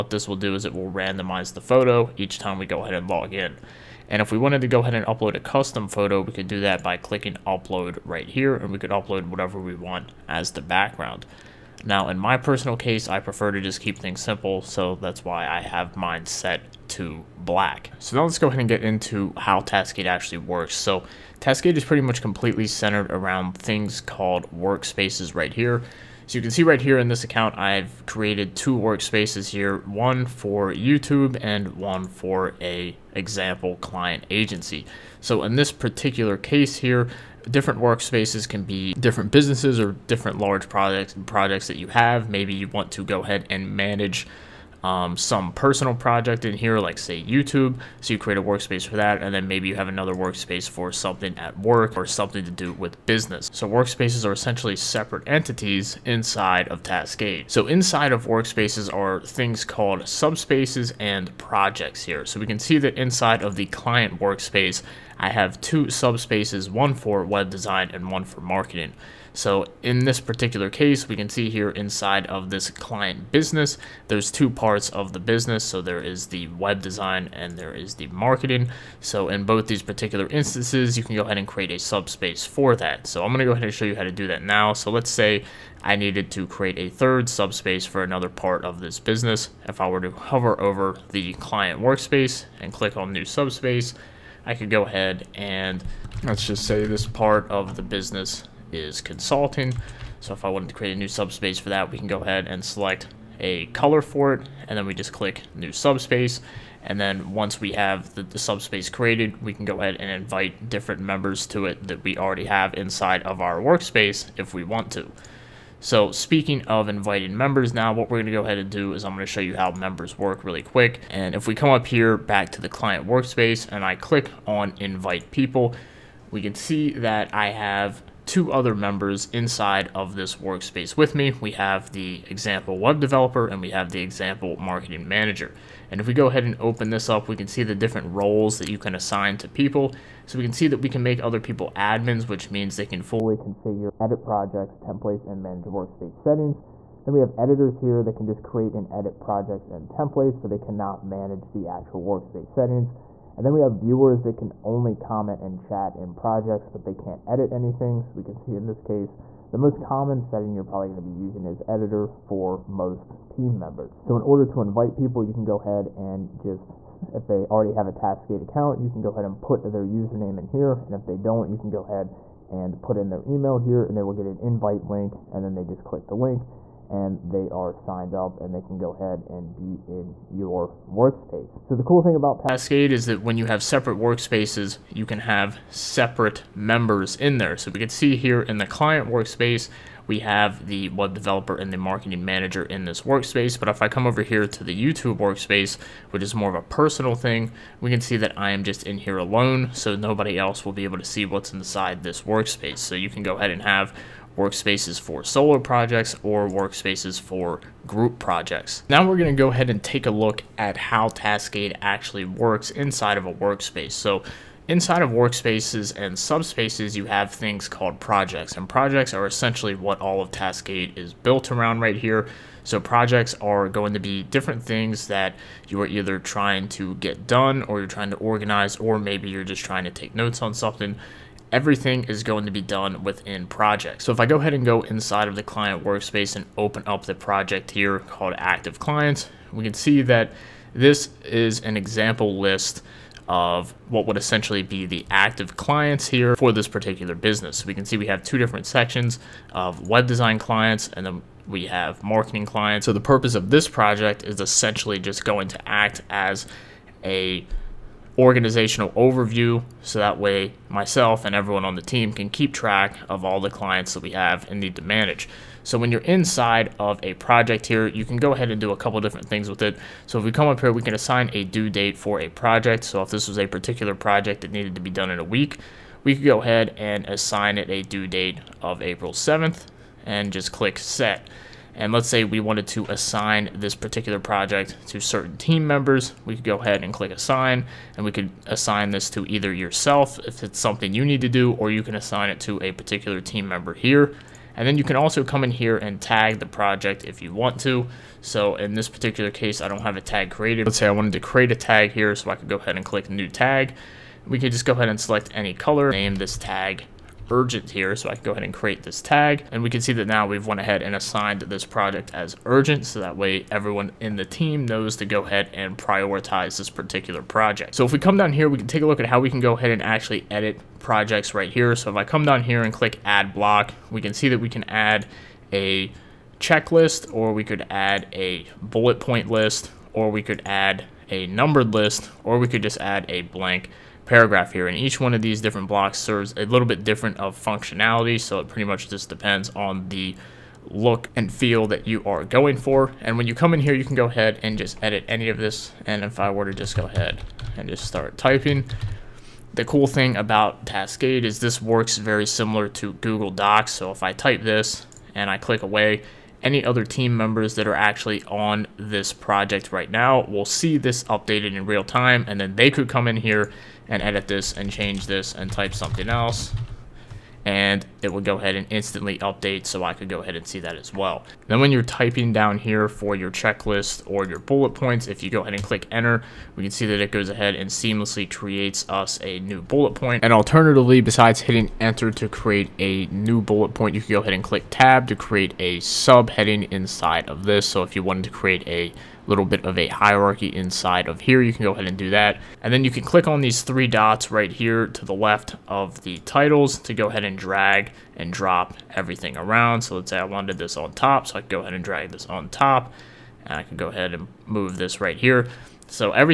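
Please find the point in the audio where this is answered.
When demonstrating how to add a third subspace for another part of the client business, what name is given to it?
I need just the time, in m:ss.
1:39.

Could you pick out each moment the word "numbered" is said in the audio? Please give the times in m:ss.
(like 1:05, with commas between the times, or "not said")
5:31.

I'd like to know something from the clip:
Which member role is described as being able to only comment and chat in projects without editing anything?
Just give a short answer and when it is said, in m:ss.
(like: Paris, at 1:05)
Viewers, at 2:33.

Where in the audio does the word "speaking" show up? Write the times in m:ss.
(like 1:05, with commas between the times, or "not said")
1:56.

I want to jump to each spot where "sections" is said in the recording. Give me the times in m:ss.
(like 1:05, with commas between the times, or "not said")
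4:08.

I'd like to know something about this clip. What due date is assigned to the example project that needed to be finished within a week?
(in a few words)
April 7th.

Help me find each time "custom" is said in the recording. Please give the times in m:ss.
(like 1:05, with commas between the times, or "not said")
0:05.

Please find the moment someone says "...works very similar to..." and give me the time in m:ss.
5:51.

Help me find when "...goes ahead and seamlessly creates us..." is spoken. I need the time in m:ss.
6:17.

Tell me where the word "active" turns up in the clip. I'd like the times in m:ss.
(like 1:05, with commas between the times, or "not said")
3:58, 4:05.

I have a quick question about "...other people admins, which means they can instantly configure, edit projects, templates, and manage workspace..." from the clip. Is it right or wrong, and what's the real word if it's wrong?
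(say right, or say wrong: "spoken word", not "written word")
wrong: "fully", not "instantly".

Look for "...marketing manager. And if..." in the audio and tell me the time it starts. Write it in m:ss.
2:14.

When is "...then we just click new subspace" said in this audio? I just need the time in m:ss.
1:44.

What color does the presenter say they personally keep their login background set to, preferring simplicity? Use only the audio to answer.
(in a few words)
Black.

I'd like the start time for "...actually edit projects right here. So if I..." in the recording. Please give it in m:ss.
5:19.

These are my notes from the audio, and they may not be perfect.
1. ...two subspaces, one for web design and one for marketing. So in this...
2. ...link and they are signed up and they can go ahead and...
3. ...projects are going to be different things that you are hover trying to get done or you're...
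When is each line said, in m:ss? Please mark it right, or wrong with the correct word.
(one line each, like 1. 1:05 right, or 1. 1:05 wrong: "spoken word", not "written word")
1. 1:05 right
2. 2:56 right
3. 3:42 wrong: "either", not "hover".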